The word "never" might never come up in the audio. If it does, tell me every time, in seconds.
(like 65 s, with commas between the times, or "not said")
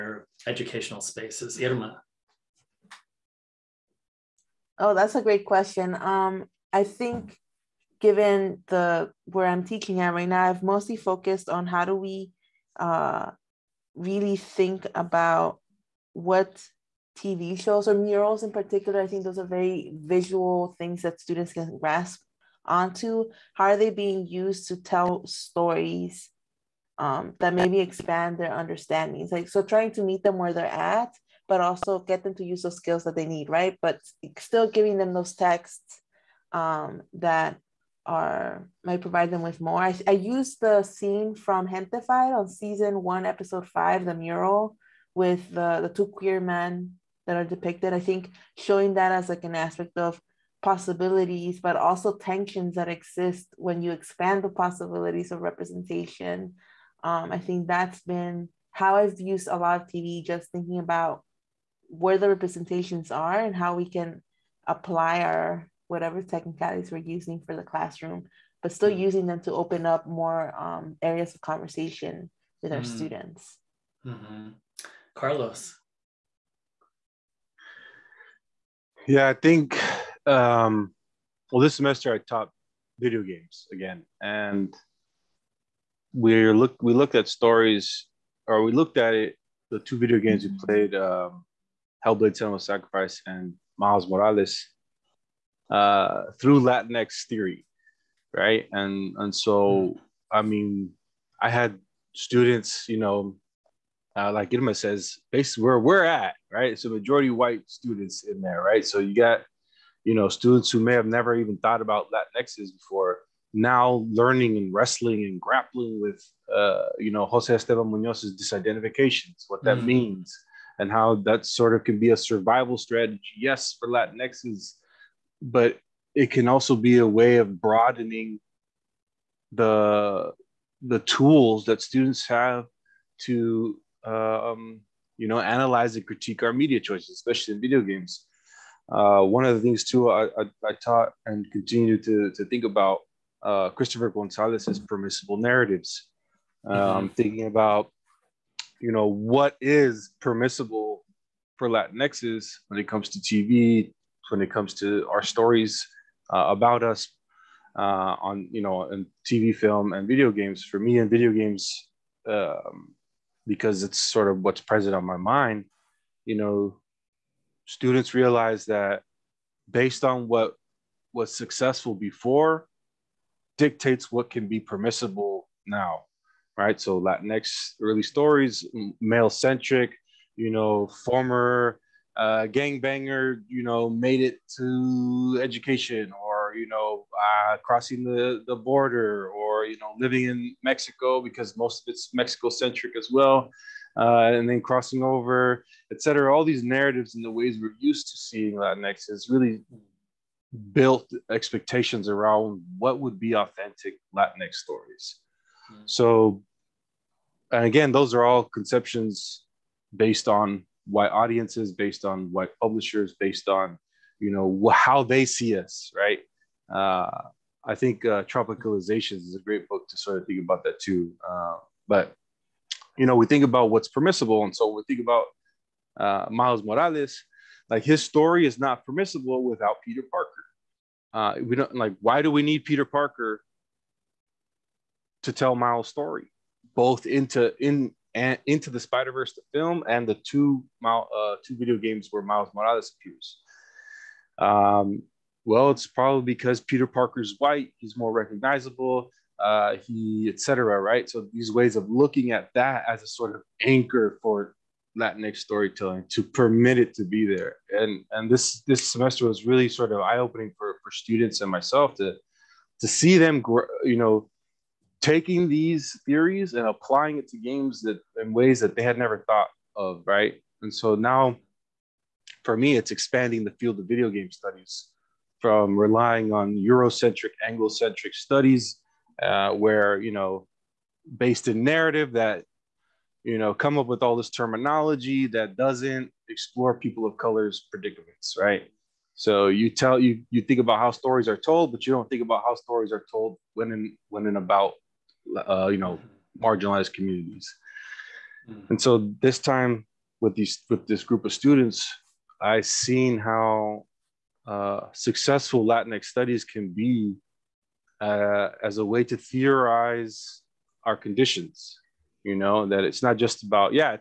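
111 s, 268 s.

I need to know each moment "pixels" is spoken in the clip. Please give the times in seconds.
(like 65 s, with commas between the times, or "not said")
not said.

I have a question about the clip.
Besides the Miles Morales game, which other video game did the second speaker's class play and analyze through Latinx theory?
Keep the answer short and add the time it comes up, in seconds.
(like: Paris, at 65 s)
Hellblade: Senua's Sacrifice, at 92 s.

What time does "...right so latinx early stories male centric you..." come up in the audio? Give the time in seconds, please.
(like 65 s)
176 s.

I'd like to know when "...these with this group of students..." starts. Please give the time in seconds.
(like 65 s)
300 s.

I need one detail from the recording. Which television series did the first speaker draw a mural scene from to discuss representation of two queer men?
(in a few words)
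Gentefied.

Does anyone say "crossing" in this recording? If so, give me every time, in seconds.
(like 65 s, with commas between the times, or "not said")
187 s, 194 s.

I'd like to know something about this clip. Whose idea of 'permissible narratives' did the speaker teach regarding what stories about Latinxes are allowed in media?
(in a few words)
Christopher Gonzalez.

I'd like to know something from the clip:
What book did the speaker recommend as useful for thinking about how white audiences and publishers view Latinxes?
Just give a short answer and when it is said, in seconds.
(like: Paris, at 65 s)
Tropicalizations, at 218 s.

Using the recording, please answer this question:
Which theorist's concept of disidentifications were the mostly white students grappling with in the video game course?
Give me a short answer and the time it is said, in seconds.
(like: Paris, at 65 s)
Jose Esteban Munoz, at 117 s.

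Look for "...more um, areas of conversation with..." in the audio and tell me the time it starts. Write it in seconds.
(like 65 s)
70 s.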